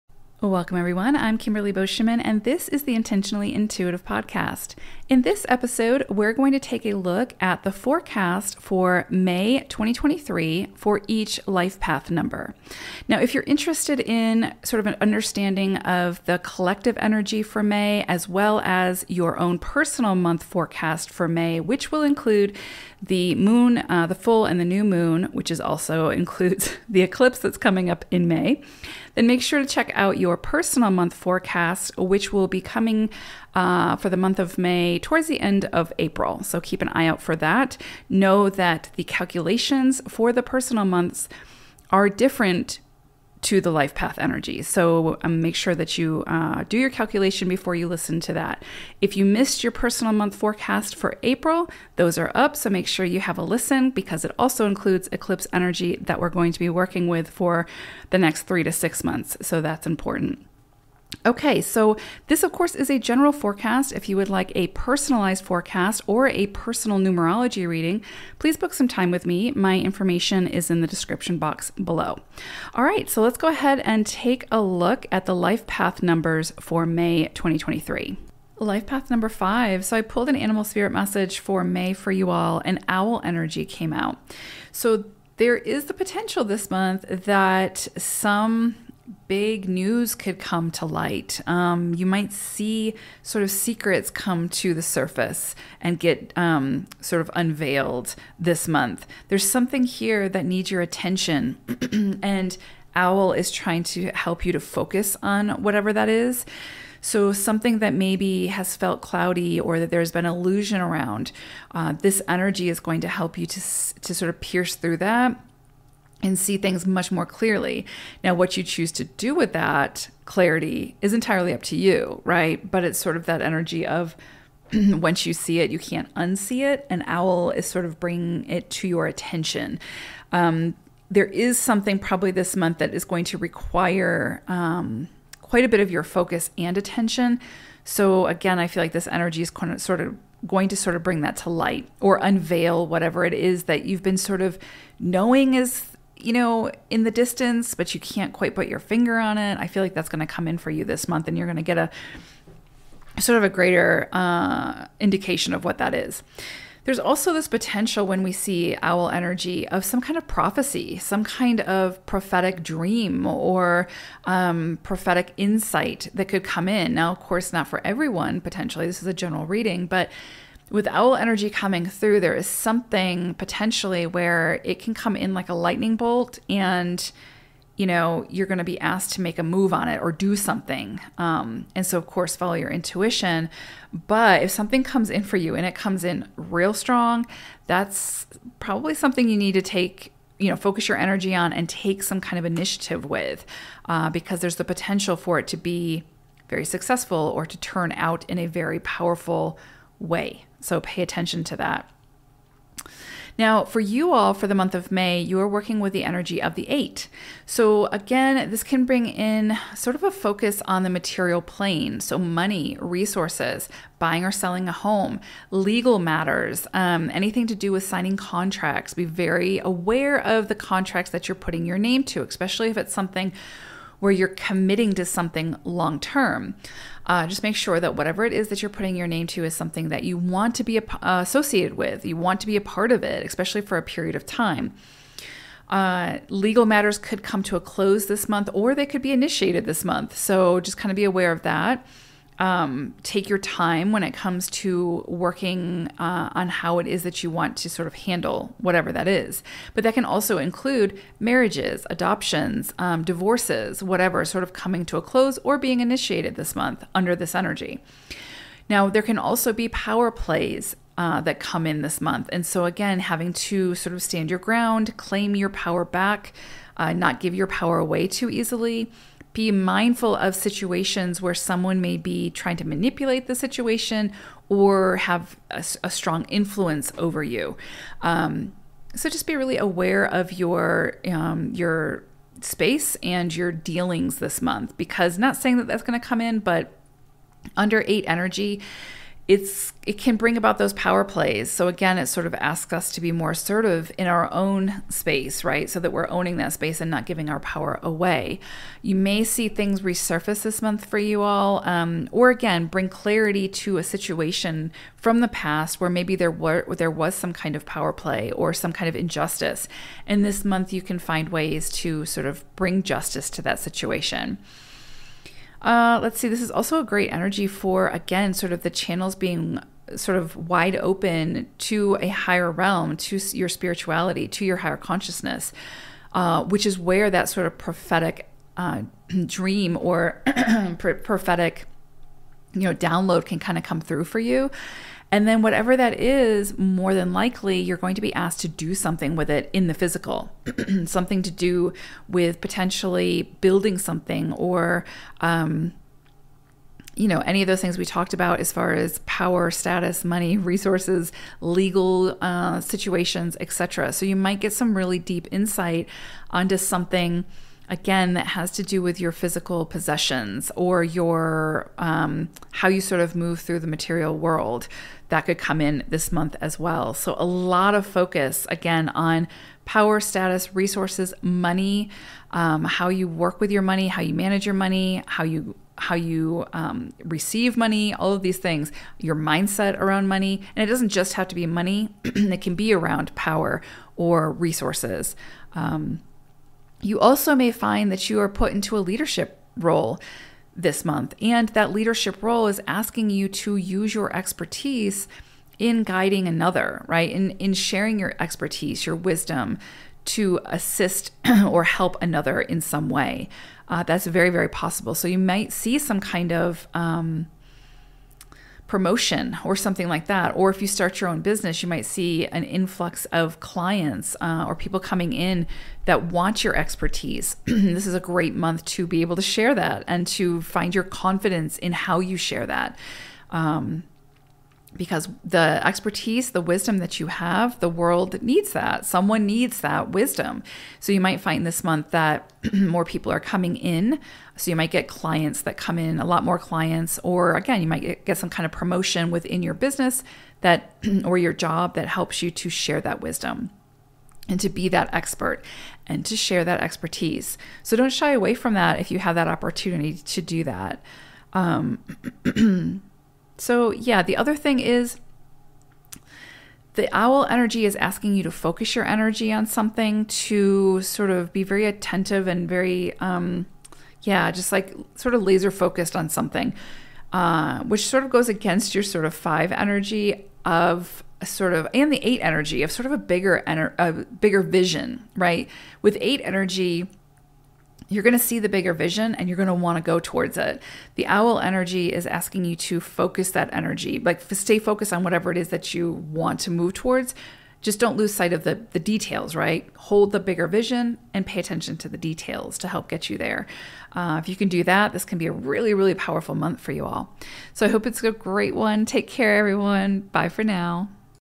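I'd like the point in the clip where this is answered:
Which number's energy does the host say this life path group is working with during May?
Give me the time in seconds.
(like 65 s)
206 s.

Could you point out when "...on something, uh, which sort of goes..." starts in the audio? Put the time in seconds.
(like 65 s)
465 s.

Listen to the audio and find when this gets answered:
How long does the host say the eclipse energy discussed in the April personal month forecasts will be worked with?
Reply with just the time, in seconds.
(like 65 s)
58 s.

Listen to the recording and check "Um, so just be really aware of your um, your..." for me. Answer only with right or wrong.
right.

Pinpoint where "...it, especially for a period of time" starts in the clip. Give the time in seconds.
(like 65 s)
233 s.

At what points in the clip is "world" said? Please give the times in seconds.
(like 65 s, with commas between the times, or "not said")
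364 s, 427 s.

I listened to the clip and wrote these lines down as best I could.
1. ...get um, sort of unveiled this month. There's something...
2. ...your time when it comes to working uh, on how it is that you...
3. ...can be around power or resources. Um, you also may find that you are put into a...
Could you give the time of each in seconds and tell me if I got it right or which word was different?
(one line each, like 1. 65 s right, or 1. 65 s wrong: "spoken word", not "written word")
1. 95 s right
2. 243 s right
3. 382 s right.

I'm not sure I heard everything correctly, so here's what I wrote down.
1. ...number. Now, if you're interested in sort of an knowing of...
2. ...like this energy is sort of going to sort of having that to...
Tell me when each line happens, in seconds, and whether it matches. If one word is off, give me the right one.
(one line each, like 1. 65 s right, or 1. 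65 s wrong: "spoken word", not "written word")
1. 12 s wrong: "understanding", not "knowing"
2. 138 s wrong: "bring", not "having".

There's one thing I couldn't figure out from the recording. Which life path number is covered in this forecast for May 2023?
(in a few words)
5.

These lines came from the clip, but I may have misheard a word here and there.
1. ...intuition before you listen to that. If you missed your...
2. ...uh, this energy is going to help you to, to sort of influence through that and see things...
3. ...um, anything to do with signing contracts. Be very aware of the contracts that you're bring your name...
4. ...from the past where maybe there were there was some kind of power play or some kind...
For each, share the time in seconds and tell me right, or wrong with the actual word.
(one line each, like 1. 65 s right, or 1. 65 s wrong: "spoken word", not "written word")
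1. 46 s wrong: "calculation", not "intuition"
2. 111 s wrong: "pierce", not "influence"
3. 216 s wrong: "putting", not "bring"
4. 304 s right.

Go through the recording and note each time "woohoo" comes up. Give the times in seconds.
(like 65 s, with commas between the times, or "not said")
not said.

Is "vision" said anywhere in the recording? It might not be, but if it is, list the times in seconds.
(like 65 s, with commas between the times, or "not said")
474 s, 478 s, 490 s.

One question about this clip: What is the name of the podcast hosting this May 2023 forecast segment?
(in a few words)
Intentionally Intuitive Podcast.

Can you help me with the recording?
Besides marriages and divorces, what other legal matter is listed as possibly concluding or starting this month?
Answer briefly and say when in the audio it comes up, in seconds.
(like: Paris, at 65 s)
Adoptions, at 251 s.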